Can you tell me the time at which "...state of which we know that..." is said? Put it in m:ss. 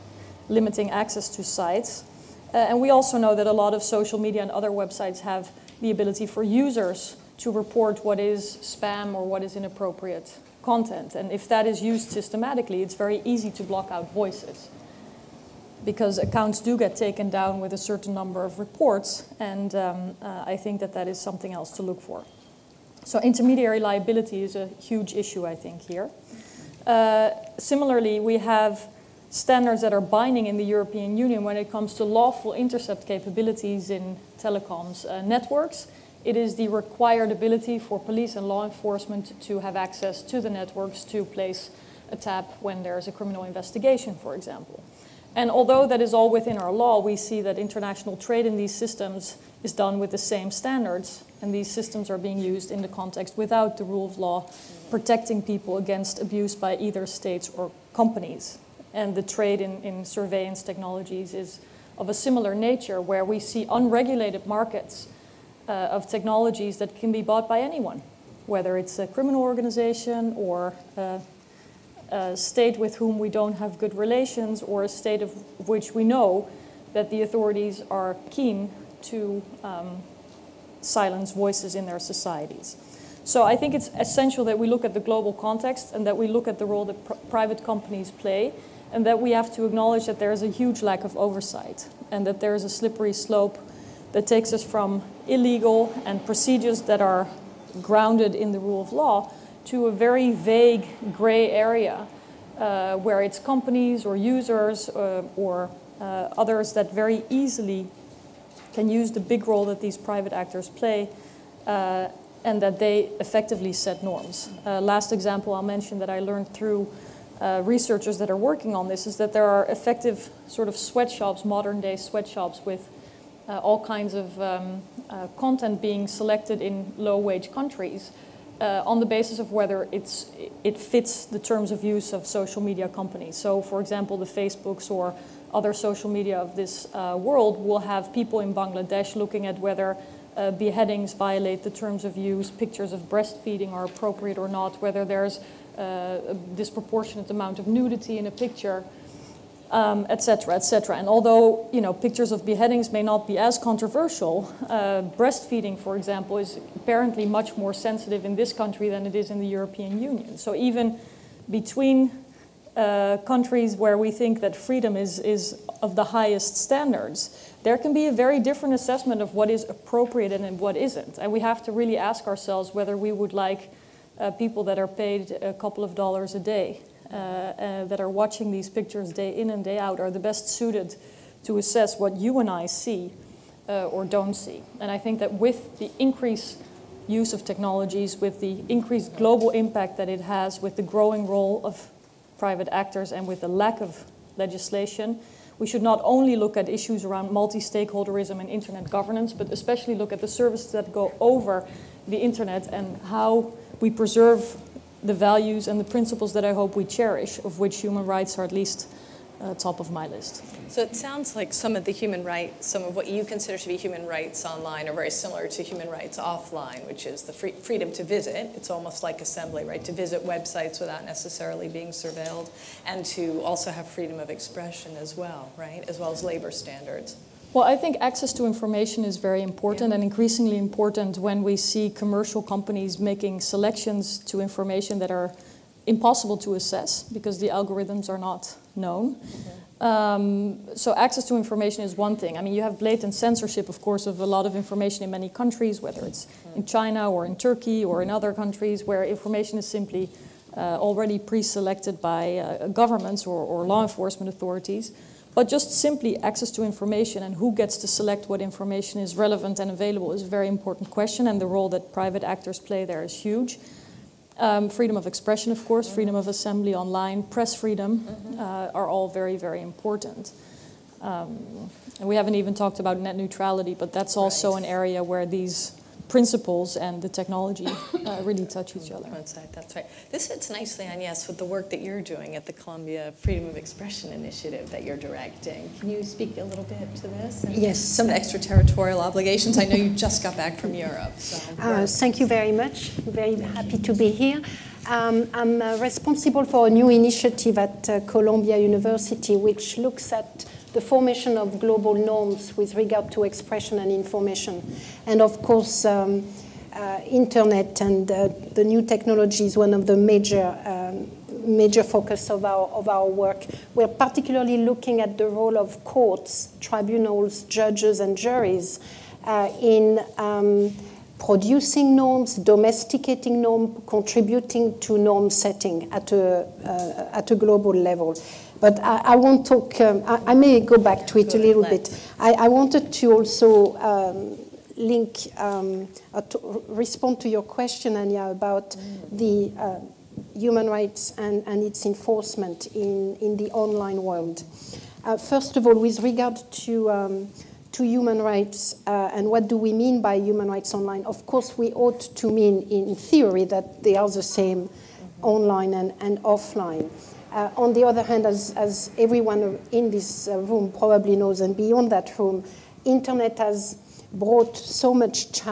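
1:14.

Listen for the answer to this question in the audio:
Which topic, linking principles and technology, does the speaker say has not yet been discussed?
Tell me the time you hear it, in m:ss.
4:32.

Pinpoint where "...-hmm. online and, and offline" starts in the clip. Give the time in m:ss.
5:54.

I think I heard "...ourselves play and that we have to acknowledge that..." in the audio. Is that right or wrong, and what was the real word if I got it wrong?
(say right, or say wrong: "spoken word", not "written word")
wrong: "companies", not "ourselves".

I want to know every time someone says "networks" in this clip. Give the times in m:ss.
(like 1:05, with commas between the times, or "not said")
0:35, 0:40.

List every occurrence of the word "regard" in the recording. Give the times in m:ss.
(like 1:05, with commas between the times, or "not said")
5:02, 5:45.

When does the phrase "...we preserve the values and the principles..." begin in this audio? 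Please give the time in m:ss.
3:23.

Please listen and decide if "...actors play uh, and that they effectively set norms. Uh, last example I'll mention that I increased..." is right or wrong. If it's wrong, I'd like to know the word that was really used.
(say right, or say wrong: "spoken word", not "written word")
wrong: "learned", not "increased".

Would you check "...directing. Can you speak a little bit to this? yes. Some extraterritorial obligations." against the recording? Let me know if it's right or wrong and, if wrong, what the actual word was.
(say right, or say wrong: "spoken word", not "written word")
right.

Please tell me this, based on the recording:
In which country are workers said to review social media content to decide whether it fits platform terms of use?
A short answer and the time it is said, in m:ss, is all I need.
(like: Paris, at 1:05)
Bangladesh, at 2:18.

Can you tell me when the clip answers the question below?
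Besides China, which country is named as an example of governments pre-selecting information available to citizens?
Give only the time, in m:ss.
4:07.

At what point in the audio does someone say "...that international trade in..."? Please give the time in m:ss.
0:47.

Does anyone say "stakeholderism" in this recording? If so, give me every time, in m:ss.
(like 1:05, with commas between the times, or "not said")
3:17.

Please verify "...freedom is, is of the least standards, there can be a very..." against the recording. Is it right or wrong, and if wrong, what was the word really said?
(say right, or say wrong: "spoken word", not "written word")
wrong: "highest", not "least".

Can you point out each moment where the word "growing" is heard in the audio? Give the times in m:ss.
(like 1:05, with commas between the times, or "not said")
3:10.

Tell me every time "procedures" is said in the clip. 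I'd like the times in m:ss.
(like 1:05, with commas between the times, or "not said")
1:36.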